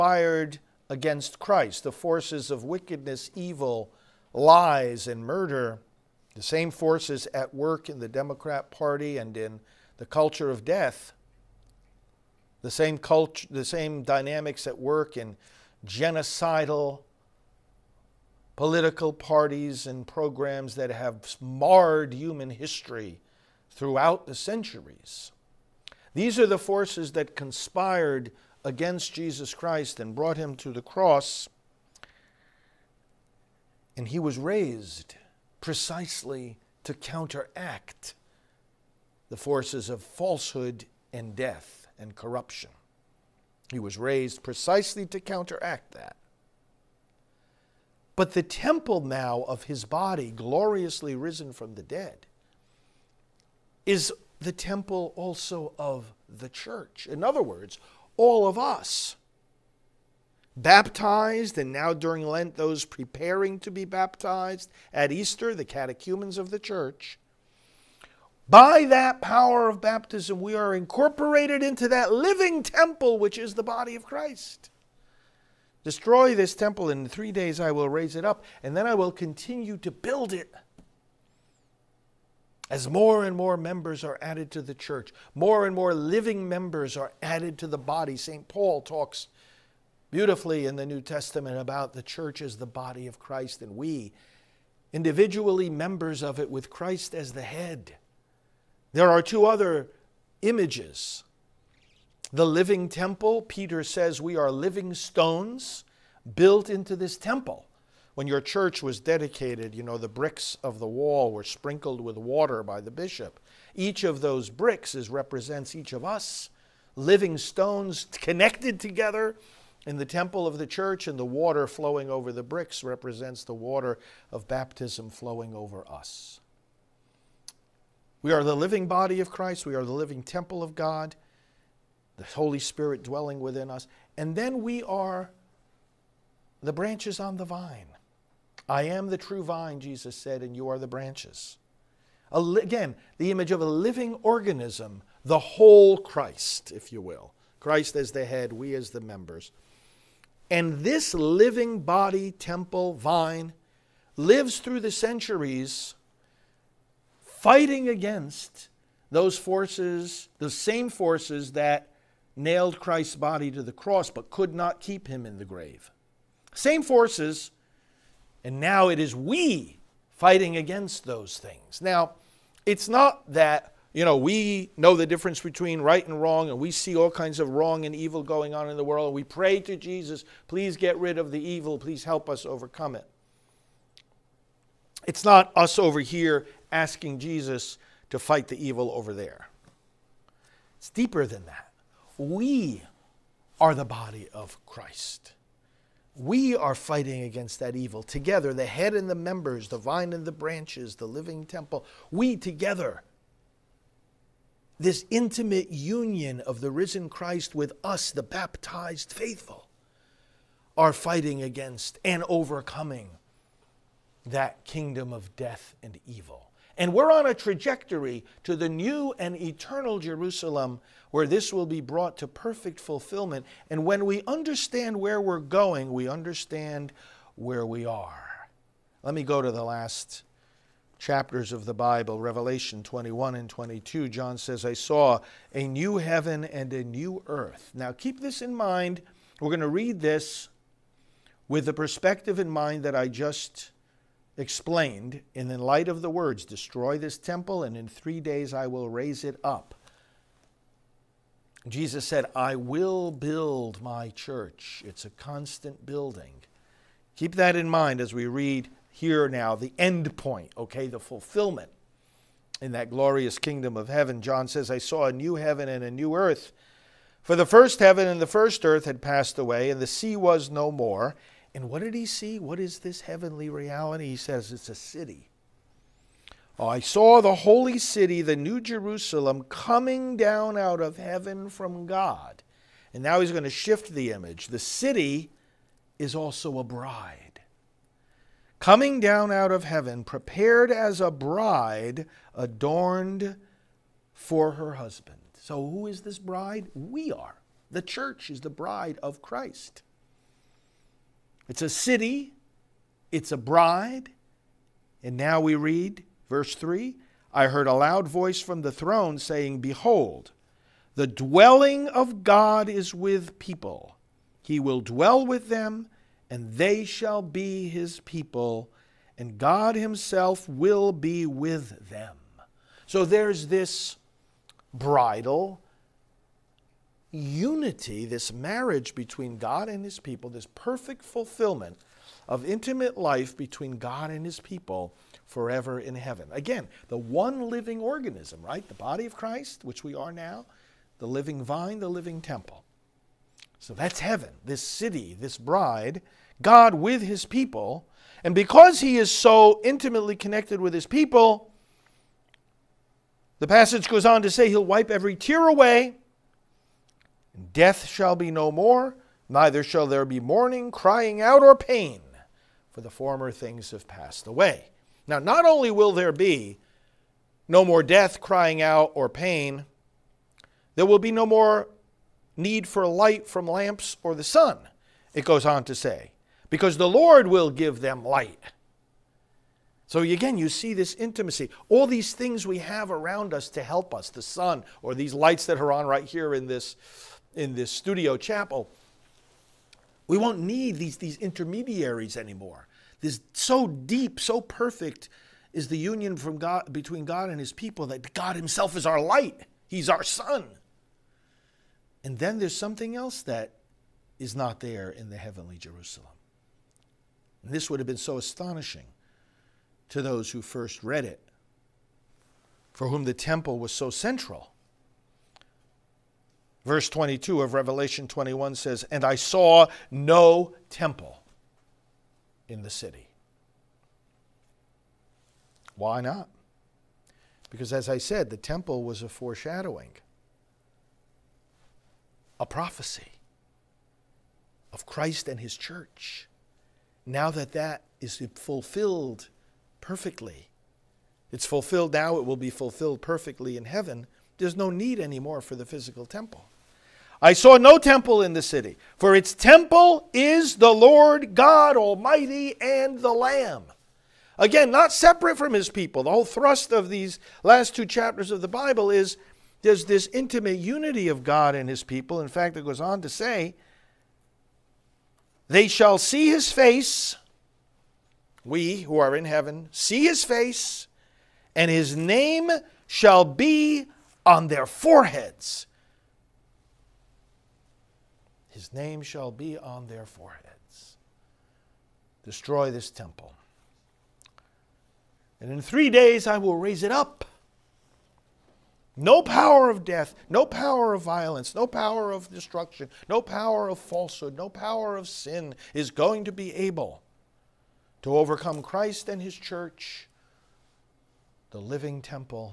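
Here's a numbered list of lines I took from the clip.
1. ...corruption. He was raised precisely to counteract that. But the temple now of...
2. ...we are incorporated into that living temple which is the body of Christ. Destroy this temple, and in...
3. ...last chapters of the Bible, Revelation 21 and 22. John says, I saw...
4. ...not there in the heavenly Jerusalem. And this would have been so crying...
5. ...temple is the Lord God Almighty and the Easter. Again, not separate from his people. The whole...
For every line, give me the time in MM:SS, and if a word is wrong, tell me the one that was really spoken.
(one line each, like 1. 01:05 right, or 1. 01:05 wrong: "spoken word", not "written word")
1. 00:42 right
2. 01:10 right
3. 03:49 right
4. 06:44 wrong: "astonishing", not "crying"
5. 07:29 wrong: "Lamb", not "Easter".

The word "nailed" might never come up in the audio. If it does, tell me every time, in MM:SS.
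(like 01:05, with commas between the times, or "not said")
02:42.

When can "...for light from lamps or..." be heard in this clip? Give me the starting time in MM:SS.
06:12.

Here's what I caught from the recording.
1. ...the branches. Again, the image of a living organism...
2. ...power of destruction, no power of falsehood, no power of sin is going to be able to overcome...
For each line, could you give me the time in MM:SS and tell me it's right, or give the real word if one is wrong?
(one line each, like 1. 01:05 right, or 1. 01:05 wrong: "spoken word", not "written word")
1. 02:20 right
2. 08:11 right.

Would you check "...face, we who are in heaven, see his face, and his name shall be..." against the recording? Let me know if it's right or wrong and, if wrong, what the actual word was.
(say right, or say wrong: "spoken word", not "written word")
right.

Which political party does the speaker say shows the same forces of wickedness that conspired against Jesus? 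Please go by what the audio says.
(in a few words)
Democrat Party.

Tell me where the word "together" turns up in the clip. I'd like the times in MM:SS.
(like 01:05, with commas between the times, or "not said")
01:58, 03:18, 03:22.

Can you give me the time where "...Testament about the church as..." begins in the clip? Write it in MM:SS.
01:31.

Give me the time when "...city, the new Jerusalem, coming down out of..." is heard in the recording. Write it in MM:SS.
04:37.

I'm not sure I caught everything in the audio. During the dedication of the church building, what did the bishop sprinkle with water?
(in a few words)
the bricks of the wall.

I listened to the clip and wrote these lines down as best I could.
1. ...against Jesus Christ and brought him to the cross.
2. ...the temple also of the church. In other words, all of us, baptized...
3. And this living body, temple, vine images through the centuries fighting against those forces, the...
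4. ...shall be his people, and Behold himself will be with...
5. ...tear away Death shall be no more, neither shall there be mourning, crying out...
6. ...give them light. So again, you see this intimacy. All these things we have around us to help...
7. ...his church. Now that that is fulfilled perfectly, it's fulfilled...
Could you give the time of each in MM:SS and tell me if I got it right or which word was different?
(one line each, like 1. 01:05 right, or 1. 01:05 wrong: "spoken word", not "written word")
1. 00:28 right
2. 00:54 right
3. 02:30 wrong: "lives", not "images"
4. 05:16 wrong: "God", not "Behold"
5. 05:55 right
6. 06:17 right
7. 07:15 right.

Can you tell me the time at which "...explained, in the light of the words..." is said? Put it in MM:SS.
04:04.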